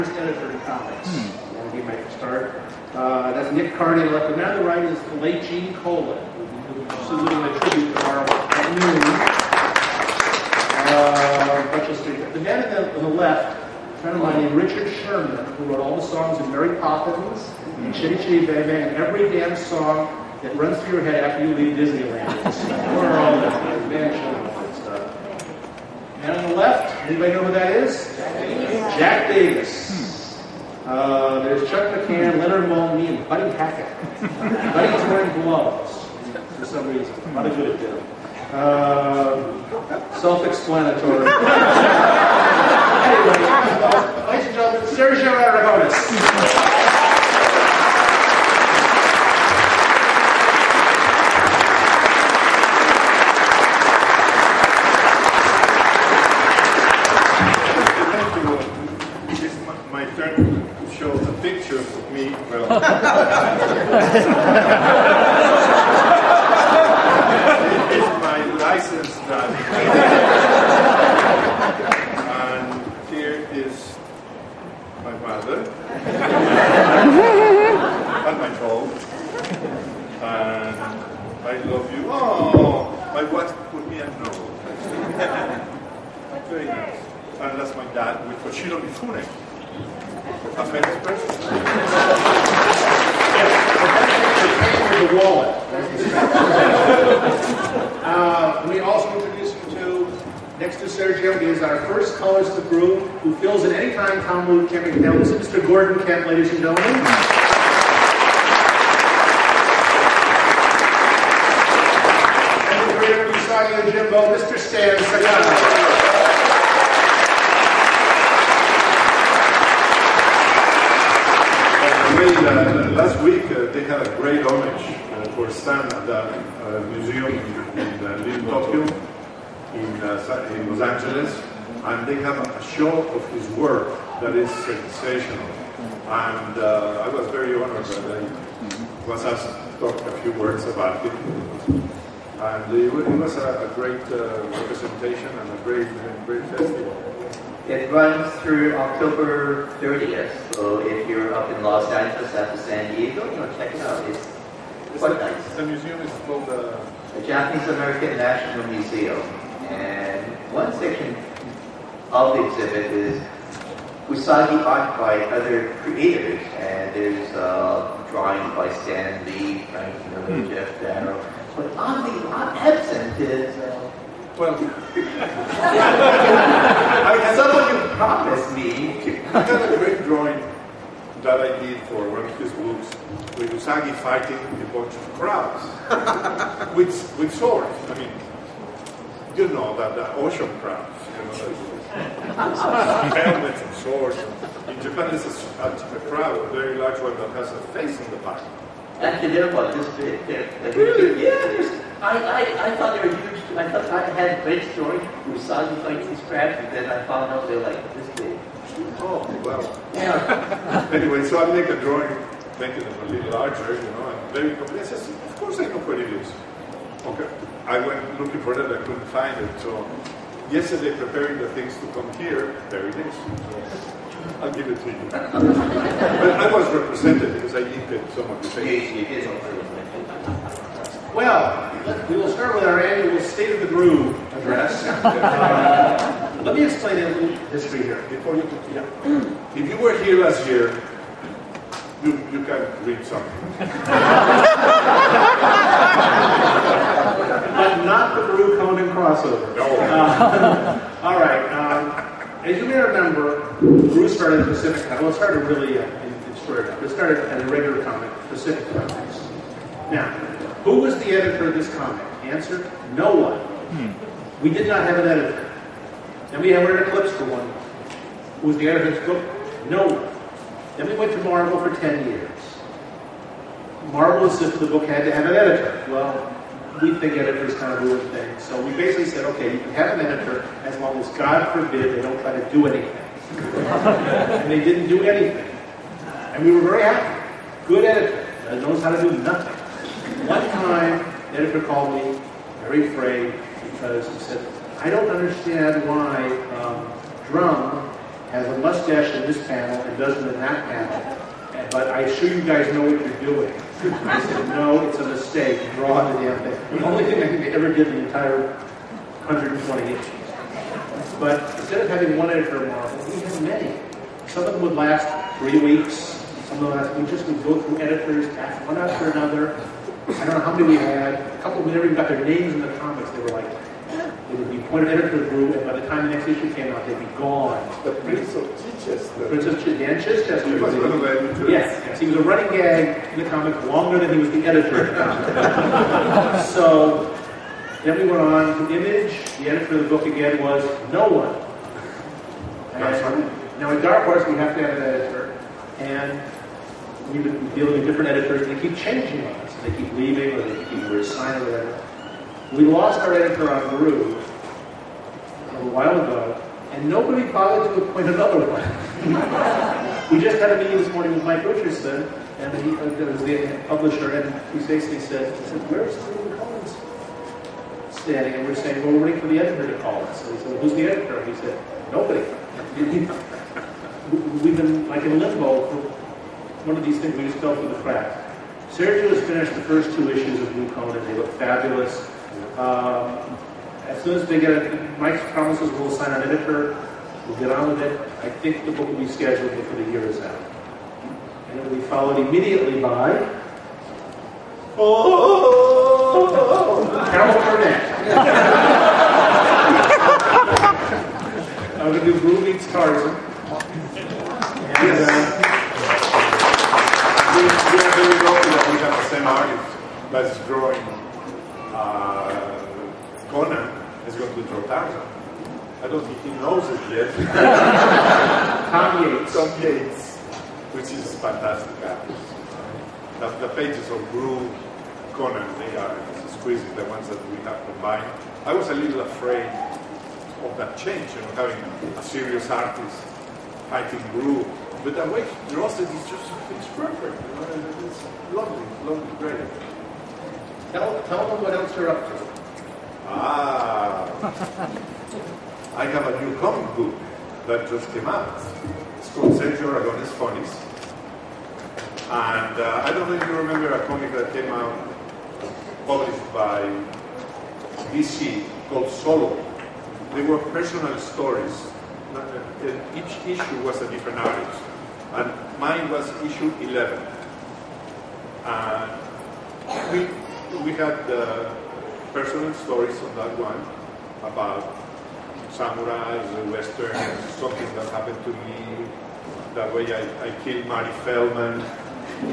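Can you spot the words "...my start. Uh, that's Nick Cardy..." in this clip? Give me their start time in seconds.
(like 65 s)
1 s.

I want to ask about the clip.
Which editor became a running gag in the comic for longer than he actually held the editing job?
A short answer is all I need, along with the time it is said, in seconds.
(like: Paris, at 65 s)
Dan Chichester, at 329 s.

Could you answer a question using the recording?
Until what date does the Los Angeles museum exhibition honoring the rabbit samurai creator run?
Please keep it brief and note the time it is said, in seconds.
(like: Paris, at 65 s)
October 30th, at 148 s.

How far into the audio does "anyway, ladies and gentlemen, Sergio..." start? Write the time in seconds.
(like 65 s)
43 s.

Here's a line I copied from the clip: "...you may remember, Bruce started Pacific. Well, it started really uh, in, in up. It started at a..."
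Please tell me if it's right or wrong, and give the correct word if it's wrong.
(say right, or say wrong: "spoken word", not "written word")
right.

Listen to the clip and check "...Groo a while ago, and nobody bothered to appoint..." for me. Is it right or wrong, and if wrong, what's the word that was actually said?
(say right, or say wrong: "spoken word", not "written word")
right.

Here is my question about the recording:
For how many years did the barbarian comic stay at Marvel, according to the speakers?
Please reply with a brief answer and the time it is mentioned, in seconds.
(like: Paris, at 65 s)
10, at 271 s.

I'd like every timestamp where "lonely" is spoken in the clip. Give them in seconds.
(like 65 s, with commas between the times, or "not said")
not said.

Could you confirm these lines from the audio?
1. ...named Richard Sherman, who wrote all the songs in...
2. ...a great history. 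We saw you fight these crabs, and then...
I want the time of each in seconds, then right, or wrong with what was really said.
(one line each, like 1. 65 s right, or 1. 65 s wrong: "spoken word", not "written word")
1. 14 s right
2. 204 s wrong: "story", not "history".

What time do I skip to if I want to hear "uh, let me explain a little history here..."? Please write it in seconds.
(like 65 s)
234 s.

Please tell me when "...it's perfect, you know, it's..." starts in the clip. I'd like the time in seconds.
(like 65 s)
436 s.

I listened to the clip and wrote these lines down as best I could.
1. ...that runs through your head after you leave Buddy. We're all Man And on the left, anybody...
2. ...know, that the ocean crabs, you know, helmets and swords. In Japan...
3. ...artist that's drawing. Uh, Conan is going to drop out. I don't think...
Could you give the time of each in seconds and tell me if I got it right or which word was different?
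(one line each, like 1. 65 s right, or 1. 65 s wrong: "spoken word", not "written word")
1. 20 s wrong: "Disneyland", not "Buddy"
2. 189 s right
3. 409 s right.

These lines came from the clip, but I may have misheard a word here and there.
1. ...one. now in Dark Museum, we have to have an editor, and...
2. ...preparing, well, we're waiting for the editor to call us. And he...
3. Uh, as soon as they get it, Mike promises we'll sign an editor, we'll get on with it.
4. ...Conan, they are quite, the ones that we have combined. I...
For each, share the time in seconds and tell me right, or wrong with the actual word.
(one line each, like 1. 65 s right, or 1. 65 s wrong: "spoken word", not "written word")
1. 341 s wrong: "Horse", not "Museum"
2. 368 s wrong: "saying", not "preparing"
3. 382 s right
4. 425 s wrong: "exquisite", not "quite".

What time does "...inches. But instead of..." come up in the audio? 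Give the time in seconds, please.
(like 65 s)
309 s.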